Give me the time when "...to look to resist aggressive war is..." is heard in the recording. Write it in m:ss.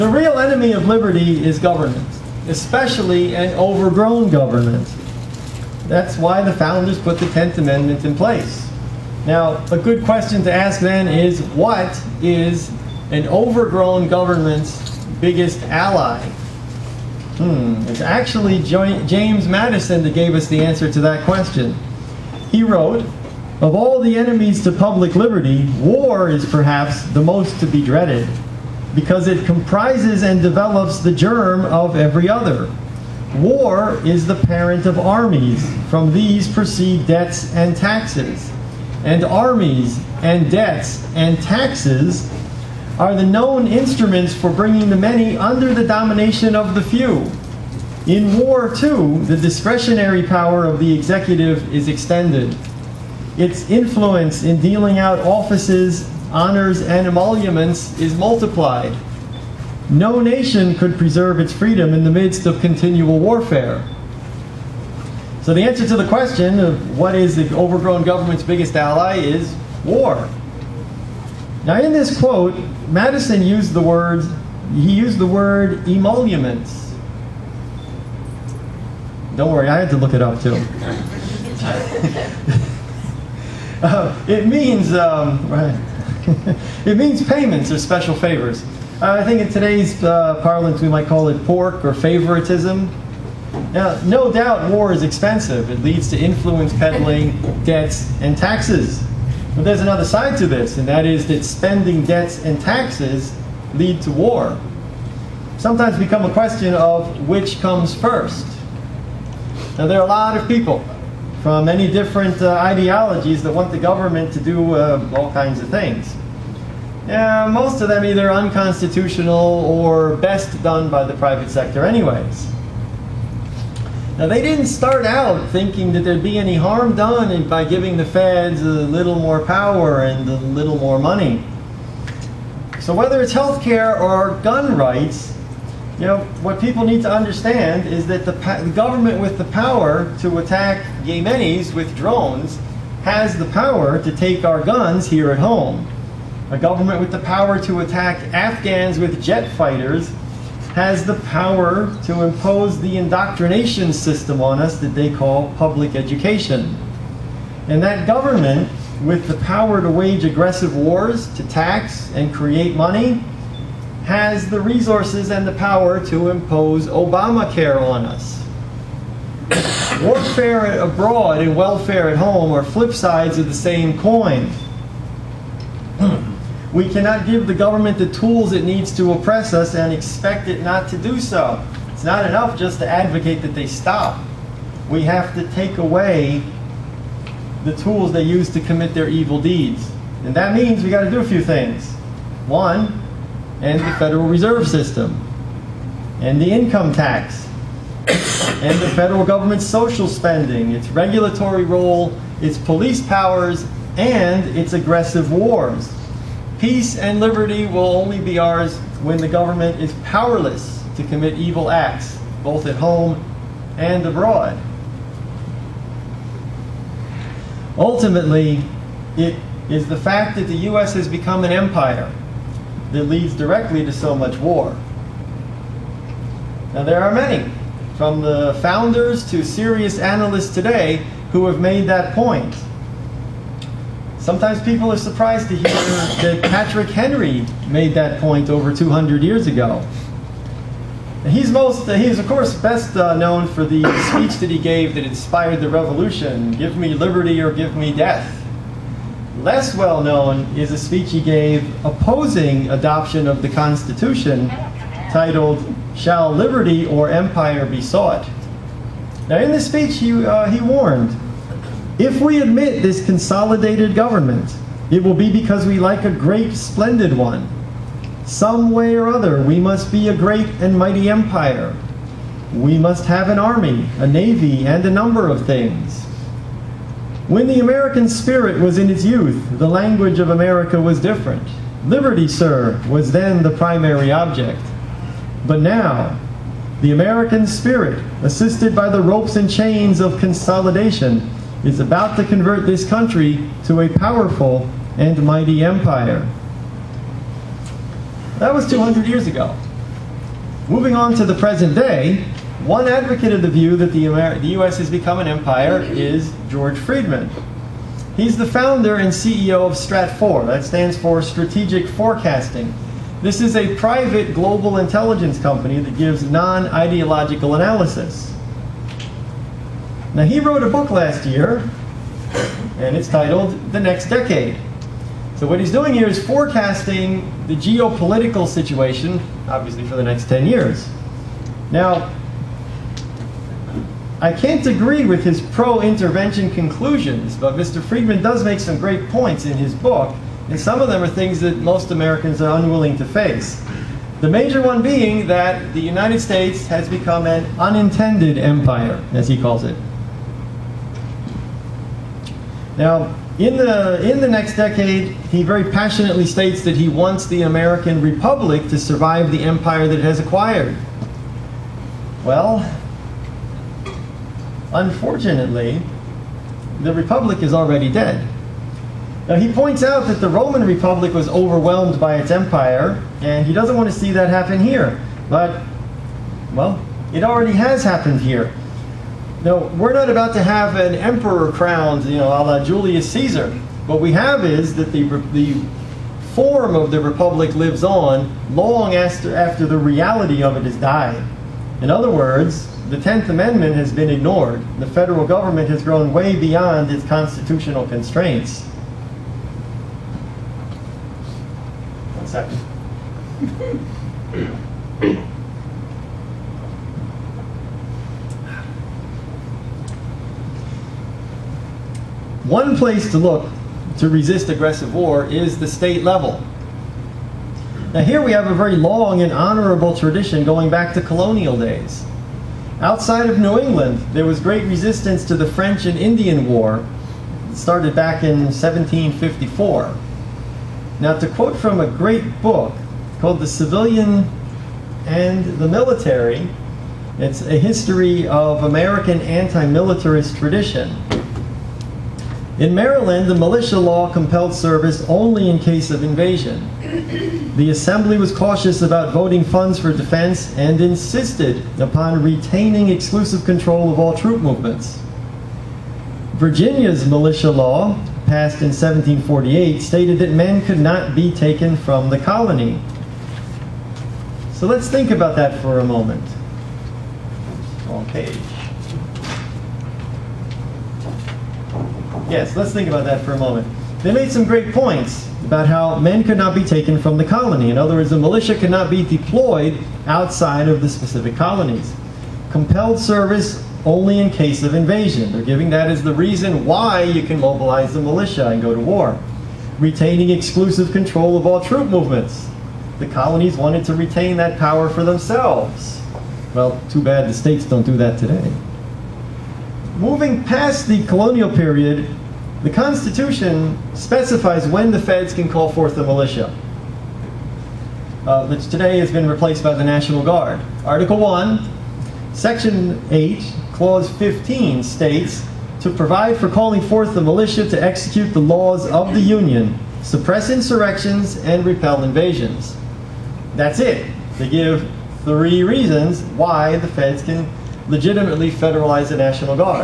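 6:53.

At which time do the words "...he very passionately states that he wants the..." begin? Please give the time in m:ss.
5:55.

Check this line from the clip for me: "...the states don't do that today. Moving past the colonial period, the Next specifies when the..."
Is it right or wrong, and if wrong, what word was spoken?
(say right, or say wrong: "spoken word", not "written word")
wrong: "Constitution", not "Next".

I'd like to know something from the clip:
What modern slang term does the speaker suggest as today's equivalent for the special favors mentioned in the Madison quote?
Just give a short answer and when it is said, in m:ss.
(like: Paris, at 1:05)
pork, at 1:31.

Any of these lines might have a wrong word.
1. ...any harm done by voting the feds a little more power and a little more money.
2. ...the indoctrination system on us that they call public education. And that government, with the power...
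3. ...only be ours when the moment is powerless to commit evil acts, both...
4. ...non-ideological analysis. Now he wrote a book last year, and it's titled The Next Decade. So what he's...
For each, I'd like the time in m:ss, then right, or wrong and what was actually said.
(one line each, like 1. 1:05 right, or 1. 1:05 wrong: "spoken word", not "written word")
1. 2:06 wrong: "giving", not "voting"
2. 2:32 right
3. 3:27 wrong: "government", not "moment"
4. 5:16 right.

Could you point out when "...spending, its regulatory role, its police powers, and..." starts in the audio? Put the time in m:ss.
3:20.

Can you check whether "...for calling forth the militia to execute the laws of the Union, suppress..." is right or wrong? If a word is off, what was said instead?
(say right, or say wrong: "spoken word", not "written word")
right.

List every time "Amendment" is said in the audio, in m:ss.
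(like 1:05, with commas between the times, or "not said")
0:07, 6:33.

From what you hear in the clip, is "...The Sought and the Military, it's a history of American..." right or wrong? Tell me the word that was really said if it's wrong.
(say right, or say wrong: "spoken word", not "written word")
wrong: "Civilian", not "Sought".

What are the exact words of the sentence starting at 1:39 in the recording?
But there's another side to this, and that is that spending debts and taxes lead to war.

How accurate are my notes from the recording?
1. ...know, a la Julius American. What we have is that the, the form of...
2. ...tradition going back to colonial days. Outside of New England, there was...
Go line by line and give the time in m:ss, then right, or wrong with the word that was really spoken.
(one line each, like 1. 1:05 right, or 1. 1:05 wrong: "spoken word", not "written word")
1. 6:22 wrong: "Caesar", not "American"
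2. 6:59 right.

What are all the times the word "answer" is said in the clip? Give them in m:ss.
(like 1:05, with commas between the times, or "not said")
0:20, 1:05.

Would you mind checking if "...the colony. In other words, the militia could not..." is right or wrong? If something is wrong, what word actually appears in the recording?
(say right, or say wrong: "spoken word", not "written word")
right.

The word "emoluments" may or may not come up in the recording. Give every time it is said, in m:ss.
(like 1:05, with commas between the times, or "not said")
0:57, 1:15.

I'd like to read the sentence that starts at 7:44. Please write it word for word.
So let's think about that for a moment.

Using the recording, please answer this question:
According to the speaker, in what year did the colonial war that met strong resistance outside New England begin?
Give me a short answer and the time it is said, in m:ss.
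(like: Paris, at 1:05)
1754, at 7:08.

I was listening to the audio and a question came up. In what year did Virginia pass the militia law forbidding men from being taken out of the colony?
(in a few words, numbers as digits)
1748.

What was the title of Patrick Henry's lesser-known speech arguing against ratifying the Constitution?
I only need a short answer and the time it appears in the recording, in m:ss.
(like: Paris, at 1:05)
Shall Liberty or Empire Be Sought?, at 4:15.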